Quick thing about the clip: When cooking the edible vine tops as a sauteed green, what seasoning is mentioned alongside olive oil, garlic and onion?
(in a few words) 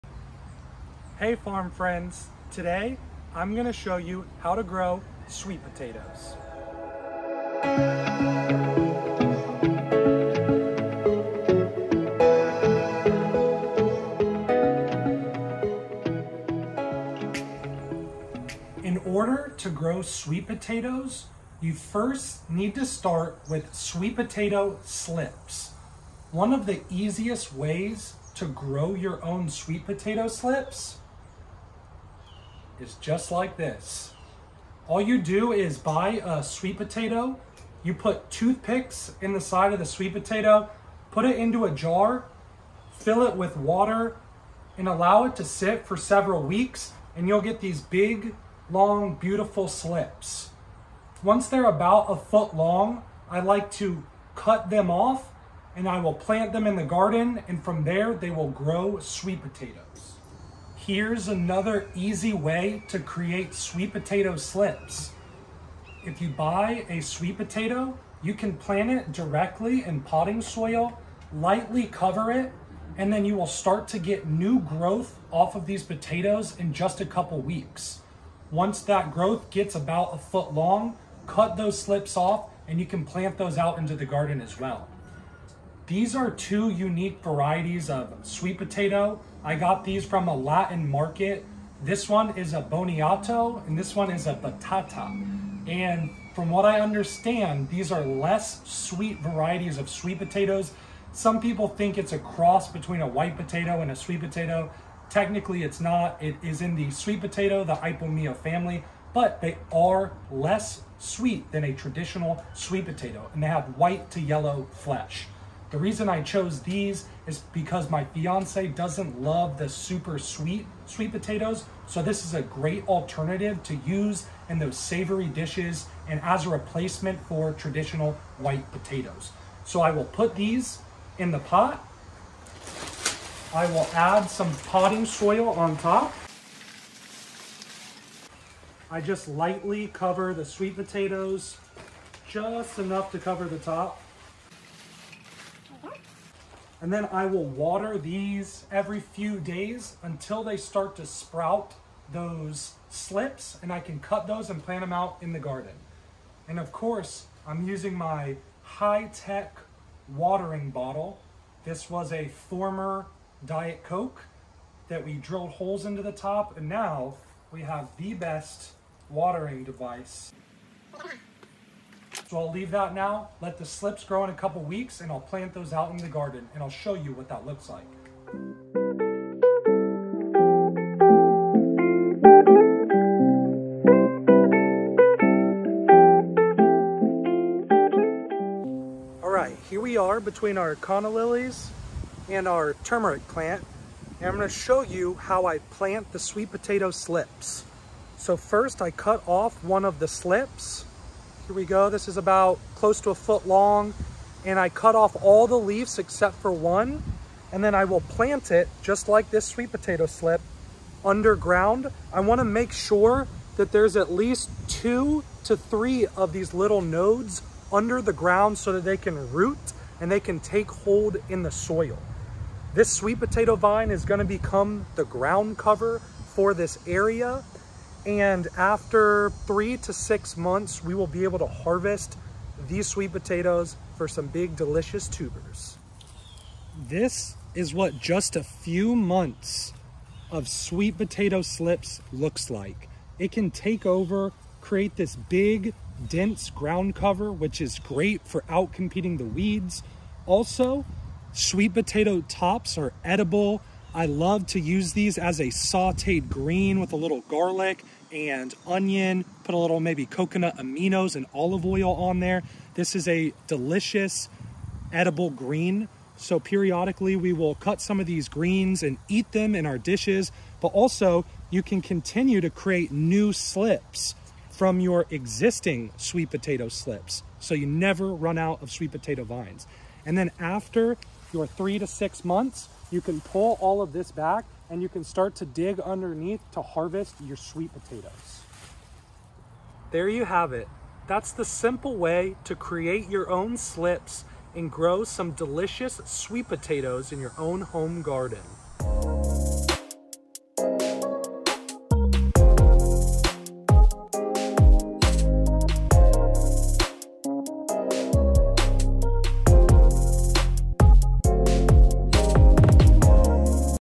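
Coconut aminos.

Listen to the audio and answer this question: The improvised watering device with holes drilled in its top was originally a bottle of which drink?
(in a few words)
Diet Coke.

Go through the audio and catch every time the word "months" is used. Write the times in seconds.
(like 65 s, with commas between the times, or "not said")
230 s, 238 s, 282 s.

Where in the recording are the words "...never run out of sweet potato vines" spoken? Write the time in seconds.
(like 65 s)
277 s.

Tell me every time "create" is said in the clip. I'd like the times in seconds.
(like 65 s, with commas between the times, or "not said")
62 s, 244 s, 272 s, 292 s.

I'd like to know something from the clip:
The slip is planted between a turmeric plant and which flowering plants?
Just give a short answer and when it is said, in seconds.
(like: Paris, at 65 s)
Canna lilies, at 190 s.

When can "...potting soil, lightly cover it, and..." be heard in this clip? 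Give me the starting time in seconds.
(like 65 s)
70 s.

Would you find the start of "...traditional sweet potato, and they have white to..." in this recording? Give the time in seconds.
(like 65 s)
111 s.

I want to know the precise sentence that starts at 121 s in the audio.
So this is a great alternative to use in those savory dishes and as a replacement for traditional white potatoes.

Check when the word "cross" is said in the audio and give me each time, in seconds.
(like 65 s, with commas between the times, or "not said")
102 s.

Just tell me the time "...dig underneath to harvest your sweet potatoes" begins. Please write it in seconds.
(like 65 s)
285 s.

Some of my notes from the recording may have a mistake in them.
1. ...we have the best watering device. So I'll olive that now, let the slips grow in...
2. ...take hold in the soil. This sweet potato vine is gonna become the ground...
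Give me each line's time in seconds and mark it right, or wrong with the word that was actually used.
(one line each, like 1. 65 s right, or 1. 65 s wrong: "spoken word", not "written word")
1. 167 s wrong: "leave", not "olive"
2. 220 s right.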